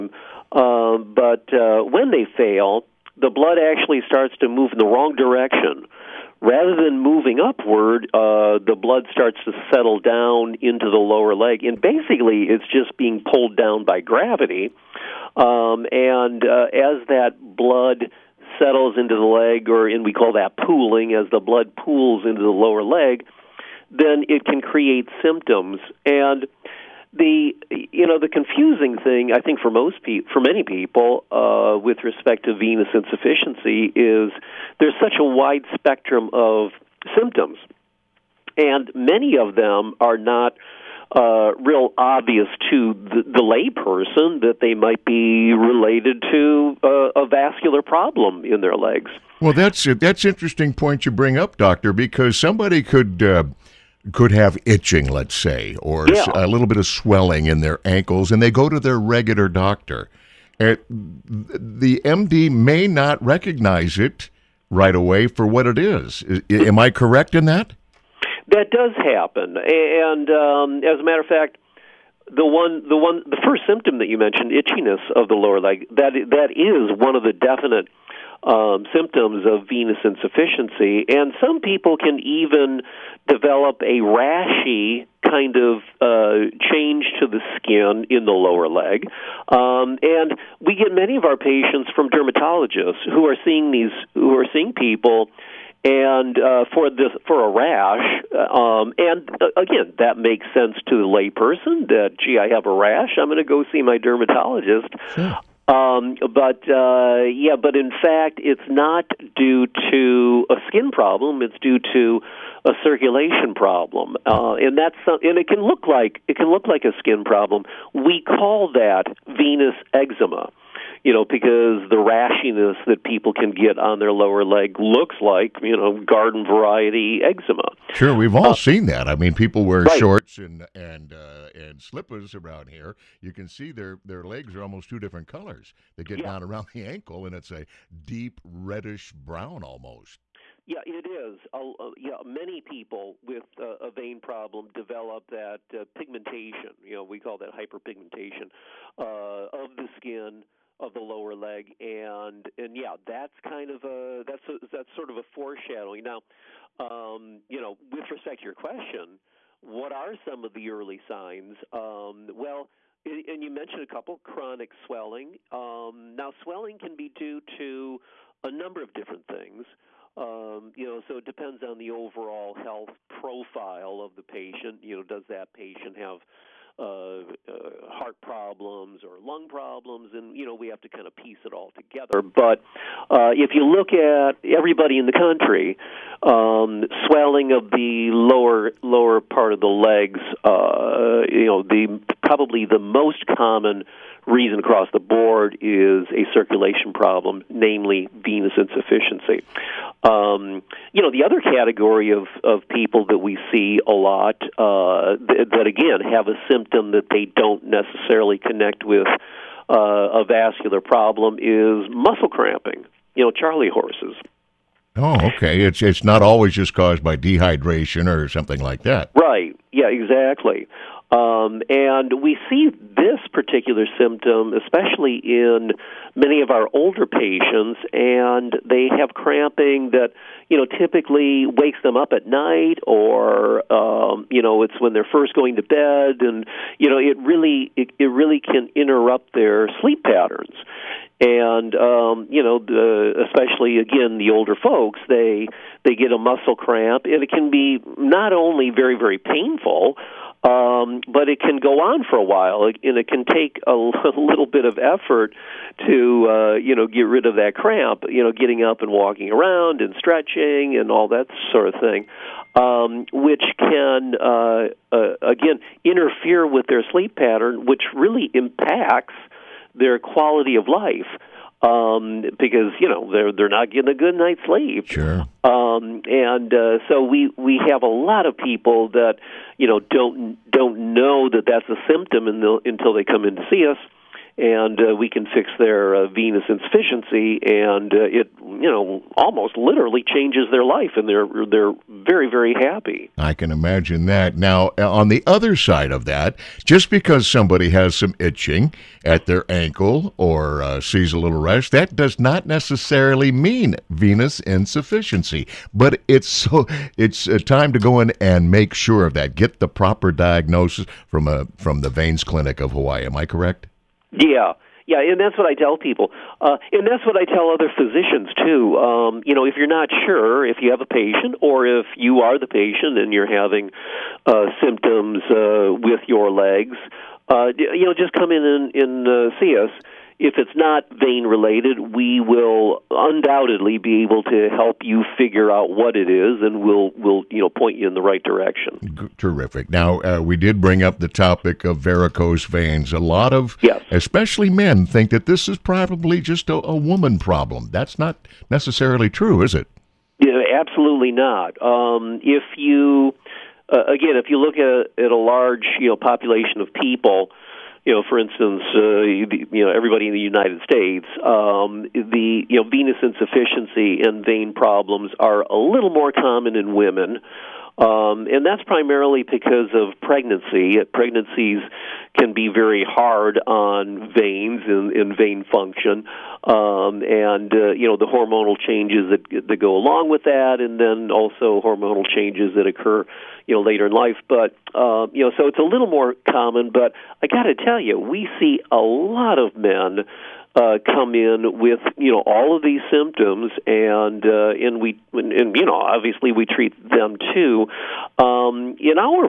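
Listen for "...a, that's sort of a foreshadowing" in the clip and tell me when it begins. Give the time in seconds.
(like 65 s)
154 s.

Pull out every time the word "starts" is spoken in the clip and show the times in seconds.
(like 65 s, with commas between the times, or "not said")
4 s, 9 s.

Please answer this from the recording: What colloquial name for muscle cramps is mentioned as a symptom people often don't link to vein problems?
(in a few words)
Charlie horses.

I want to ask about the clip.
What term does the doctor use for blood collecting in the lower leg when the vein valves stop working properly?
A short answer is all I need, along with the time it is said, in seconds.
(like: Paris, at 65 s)
pooling, at 20 s.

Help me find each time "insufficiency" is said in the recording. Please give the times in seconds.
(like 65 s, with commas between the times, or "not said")
32 s, 80 s, 198 s, 286 s, 304 s, 363 s.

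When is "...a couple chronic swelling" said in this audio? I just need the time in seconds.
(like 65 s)
163 s.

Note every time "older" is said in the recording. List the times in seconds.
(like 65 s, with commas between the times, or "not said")
226 s, 244 s.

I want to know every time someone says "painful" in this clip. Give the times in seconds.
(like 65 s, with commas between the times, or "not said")
249 s.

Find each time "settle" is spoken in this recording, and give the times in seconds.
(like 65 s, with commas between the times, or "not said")
9 s, 18 s.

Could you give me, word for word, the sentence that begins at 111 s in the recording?
It's due to a circulation problem, uh, and that's and it can look like it can look like a skin problem.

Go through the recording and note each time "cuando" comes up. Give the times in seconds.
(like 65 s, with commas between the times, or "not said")
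not said.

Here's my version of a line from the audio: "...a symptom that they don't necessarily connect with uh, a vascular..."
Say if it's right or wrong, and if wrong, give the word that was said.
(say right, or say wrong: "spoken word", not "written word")
right.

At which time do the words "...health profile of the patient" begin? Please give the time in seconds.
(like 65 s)
172 s.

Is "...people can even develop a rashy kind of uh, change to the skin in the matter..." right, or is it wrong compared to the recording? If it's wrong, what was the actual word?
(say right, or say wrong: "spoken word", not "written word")
wrong: "lower", not "matter".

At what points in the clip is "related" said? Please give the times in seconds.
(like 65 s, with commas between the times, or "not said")
45 s, 331 s.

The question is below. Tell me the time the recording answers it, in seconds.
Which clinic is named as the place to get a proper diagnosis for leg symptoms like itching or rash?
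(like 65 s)
311 s.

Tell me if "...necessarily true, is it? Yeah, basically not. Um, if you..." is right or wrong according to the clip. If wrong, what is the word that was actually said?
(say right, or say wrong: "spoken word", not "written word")
wrong: "absolutely", not "basically".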